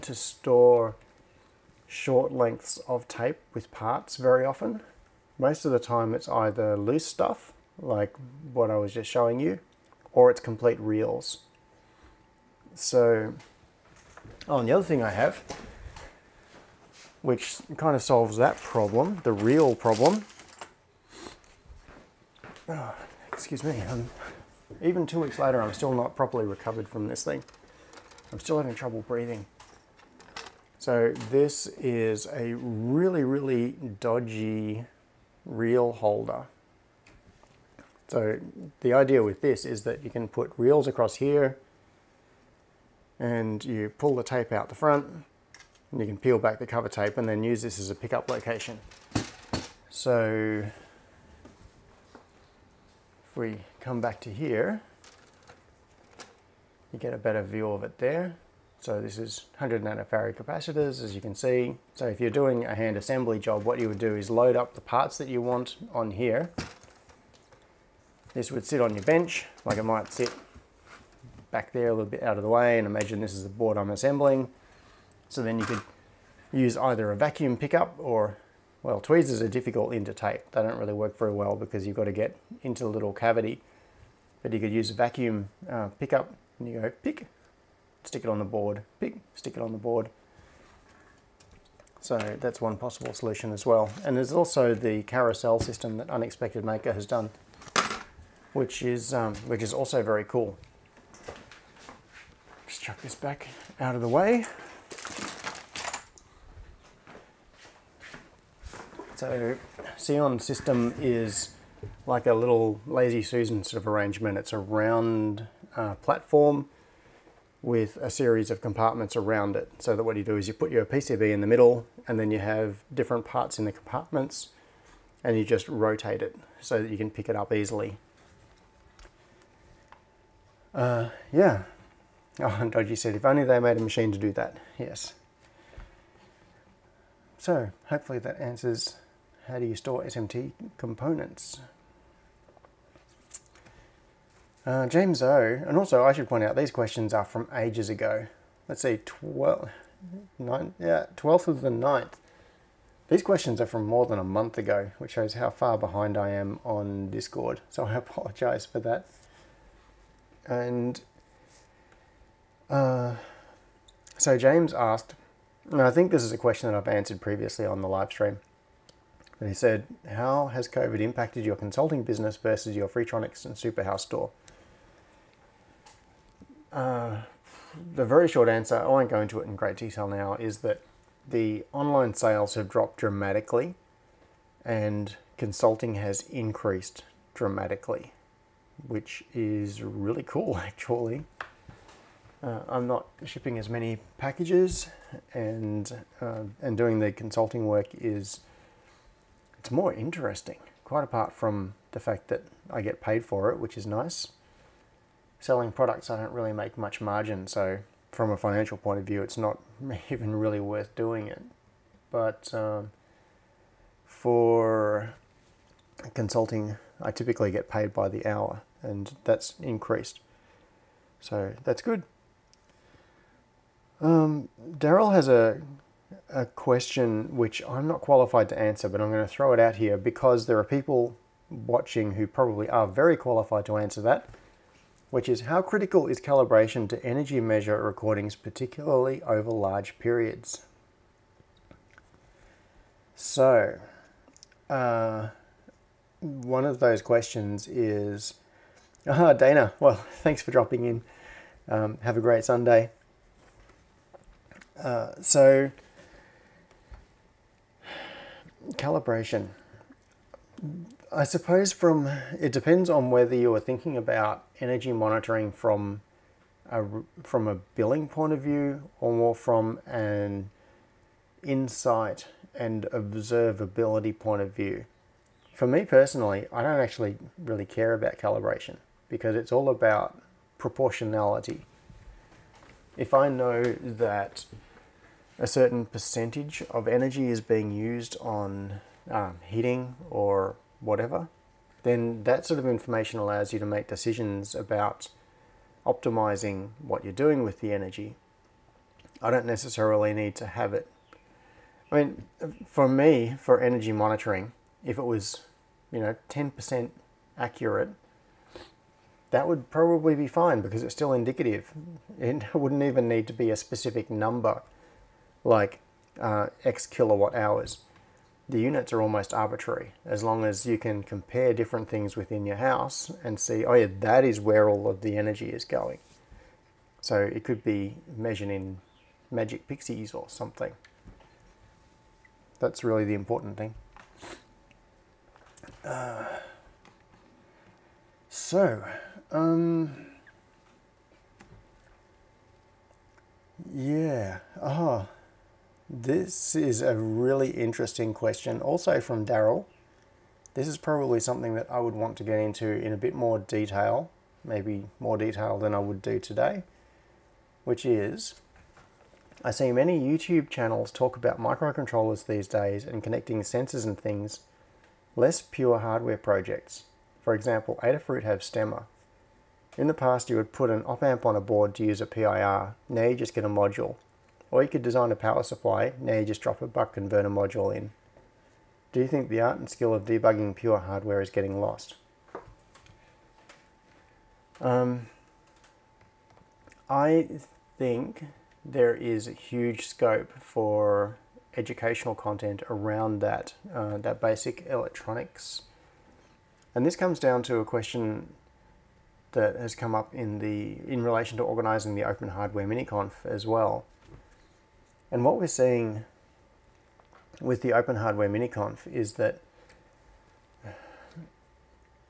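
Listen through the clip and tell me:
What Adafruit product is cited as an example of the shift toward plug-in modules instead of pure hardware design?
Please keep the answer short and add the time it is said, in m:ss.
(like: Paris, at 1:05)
STEMMA, at 6:08.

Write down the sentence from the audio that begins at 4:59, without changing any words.
I don't necessarily need to have it.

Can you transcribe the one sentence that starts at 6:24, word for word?
Um, I think there is huge scope for educational content around that, uh, that basic electronics.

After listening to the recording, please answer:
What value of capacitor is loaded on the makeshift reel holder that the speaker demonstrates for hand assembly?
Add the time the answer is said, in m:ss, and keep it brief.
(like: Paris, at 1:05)
100 nanofarad, at 0:59.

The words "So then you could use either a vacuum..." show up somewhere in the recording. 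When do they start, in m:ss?
1:15.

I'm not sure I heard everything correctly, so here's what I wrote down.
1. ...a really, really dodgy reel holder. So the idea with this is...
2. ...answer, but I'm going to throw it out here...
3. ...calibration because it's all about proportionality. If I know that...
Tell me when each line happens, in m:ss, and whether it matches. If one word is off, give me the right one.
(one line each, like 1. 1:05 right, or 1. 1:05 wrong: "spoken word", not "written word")
1. 0:32 right
2. 3:48 right
3. 4:38 right.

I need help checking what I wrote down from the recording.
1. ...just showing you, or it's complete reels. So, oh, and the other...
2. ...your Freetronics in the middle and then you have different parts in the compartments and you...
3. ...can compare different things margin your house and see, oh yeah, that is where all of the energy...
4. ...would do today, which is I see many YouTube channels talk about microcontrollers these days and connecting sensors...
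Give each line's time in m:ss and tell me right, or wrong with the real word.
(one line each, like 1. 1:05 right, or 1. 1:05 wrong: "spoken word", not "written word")
1. 0:08 right
2. 2:00 wrong: "PCB", not "Freetronics"
3. 5:20 wrong: "within", not "margin"
4. 5:55 right.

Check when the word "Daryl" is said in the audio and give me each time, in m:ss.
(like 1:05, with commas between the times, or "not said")
3:44, 5:49.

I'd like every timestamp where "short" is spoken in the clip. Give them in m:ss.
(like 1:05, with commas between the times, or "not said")
0:01, 2:58.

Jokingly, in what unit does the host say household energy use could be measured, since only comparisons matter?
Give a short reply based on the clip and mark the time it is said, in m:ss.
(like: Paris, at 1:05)
magic pixies, at 5:29.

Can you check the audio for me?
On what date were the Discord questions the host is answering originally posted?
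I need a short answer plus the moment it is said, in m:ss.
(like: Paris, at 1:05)
12th of the 9th, at 2:31.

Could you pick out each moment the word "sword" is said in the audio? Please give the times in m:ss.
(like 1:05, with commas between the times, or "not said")
not said.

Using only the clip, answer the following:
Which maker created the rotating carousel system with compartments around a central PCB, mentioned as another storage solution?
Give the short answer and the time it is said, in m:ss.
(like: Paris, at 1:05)
Unexpected Maker, at 1:36.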